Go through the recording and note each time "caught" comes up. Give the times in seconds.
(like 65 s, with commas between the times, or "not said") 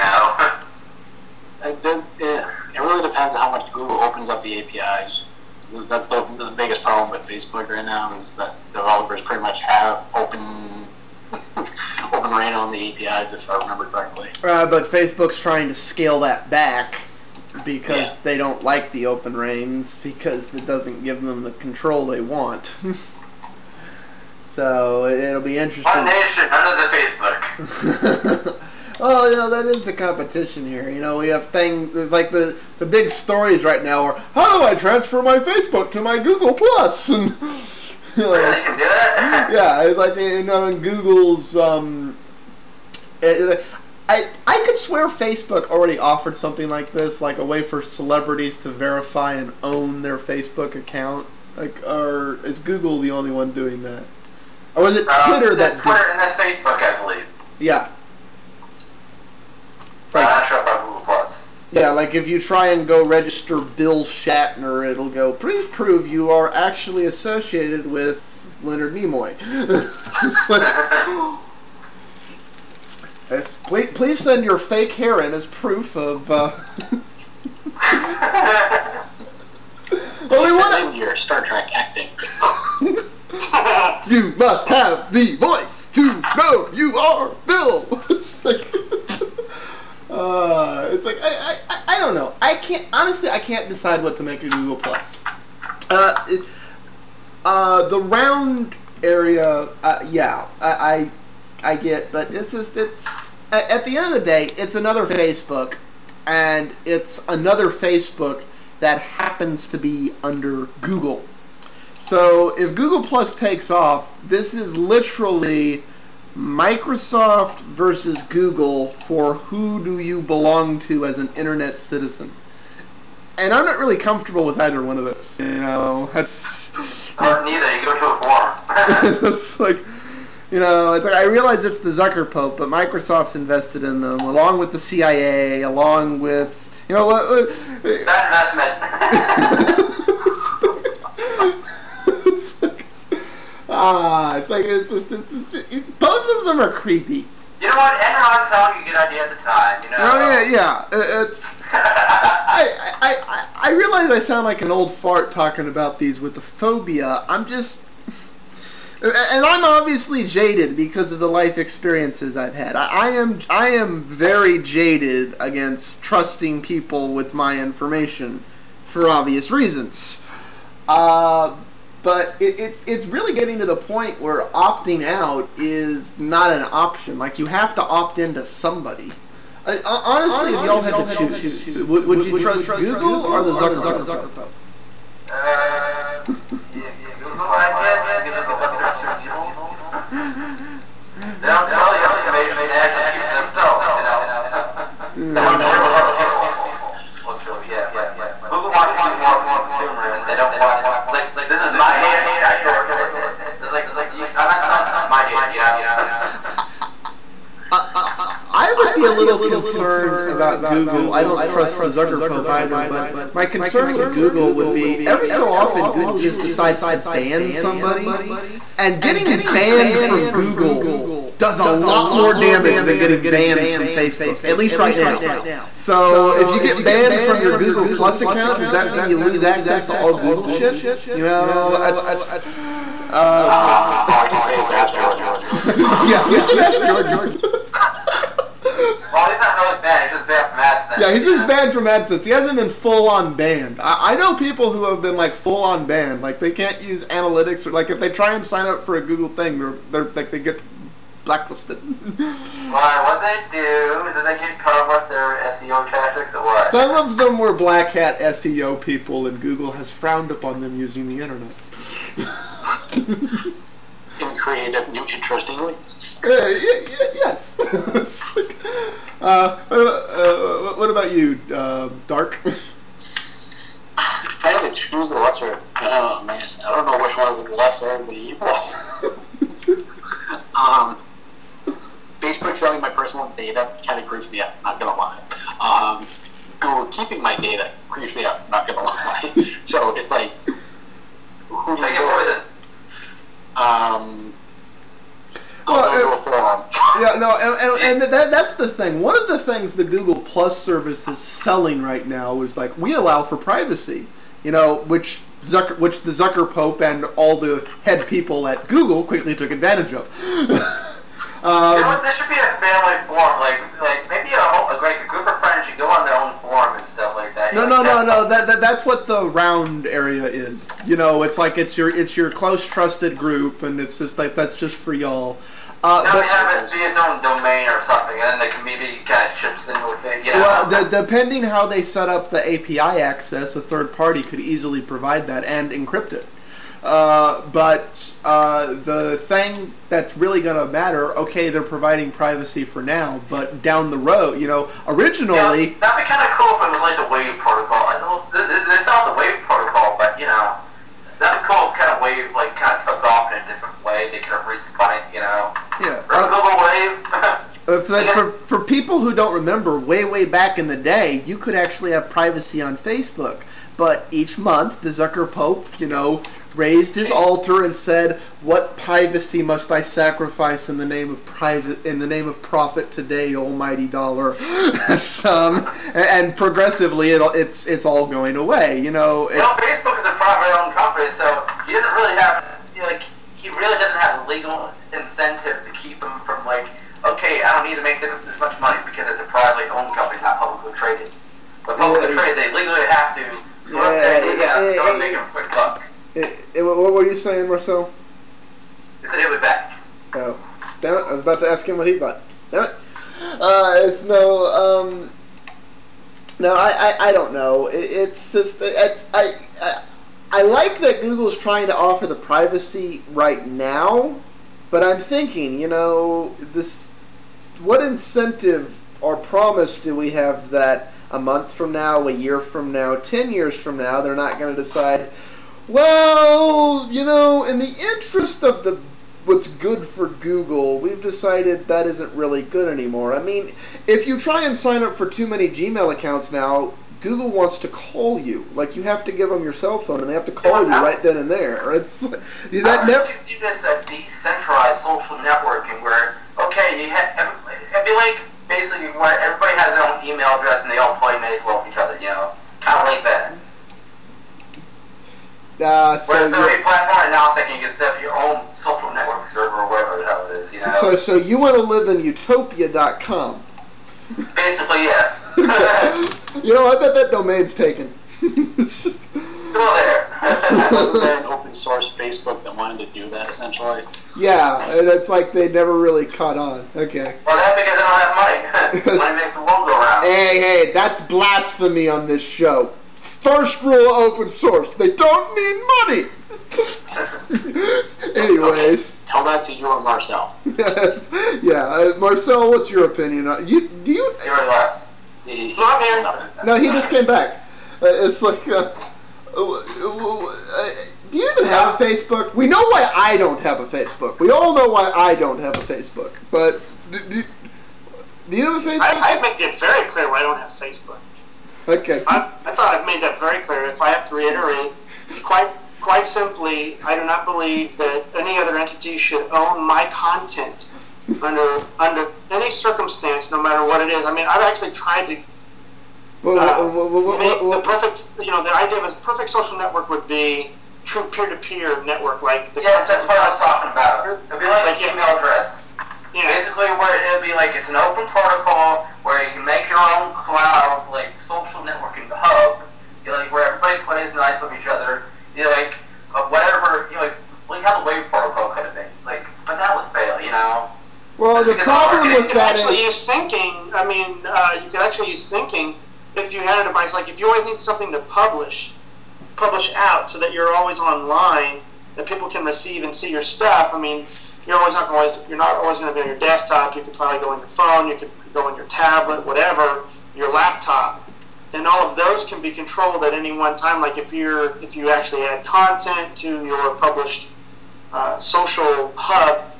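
254 s, 476 s.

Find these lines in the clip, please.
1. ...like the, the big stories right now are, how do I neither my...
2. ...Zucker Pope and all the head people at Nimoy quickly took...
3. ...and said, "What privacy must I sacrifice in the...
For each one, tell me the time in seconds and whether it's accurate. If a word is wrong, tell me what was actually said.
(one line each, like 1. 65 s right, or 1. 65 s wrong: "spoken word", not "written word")
1. 32 s wrong: "transfer", not "neither"
2. 306 s wrong: "Google", not "Nimoy"
3. 367 s right.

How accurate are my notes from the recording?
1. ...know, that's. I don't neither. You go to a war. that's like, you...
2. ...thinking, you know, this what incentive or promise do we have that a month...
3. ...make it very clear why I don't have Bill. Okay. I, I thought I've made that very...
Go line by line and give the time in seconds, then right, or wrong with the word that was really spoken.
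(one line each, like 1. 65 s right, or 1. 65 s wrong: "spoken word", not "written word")
1. 125 s right
2. 414 s right
3. 509 s wrong: "Facebook", not "Bill".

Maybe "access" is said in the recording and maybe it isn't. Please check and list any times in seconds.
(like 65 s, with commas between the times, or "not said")
229 s, 332 s.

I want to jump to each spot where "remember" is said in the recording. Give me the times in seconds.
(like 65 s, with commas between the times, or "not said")
13 s, 359 s.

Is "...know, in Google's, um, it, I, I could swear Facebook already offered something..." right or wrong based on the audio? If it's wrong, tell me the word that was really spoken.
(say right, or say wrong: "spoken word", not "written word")
right.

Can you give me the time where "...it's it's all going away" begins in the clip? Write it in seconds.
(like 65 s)
377 s.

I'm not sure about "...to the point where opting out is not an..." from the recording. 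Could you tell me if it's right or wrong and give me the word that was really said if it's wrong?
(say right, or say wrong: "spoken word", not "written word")
right.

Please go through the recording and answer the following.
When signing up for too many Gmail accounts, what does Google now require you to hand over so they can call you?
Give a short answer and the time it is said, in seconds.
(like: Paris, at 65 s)
cell phone, at 439 s.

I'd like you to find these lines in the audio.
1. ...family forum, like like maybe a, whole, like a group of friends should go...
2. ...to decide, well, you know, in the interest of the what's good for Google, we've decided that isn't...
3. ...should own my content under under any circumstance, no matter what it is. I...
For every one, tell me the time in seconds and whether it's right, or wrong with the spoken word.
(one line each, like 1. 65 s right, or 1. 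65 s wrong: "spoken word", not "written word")
1. 312 s right
2. 424 s right
3. 518 s right.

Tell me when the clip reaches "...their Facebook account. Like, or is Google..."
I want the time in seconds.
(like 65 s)
50 s.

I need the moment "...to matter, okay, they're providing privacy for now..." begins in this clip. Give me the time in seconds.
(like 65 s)
340 s.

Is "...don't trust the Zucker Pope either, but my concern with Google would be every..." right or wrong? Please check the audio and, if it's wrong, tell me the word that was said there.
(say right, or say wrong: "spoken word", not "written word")
right.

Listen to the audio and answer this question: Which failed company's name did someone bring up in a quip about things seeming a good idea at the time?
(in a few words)
Enron.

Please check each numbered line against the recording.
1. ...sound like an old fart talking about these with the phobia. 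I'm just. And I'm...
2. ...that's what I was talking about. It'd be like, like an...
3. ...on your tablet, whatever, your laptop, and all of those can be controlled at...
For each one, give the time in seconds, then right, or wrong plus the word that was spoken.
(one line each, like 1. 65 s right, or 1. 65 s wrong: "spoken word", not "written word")
1. 154 s right
2. 532 s right
3. 568 s right.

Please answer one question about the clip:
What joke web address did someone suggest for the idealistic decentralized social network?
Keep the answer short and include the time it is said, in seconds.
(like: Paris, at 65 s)
utopia.com, at 462 s.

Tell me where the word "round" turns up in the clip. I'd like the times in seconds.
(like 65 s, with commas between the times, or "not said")
98 s, 319 s, 479 s.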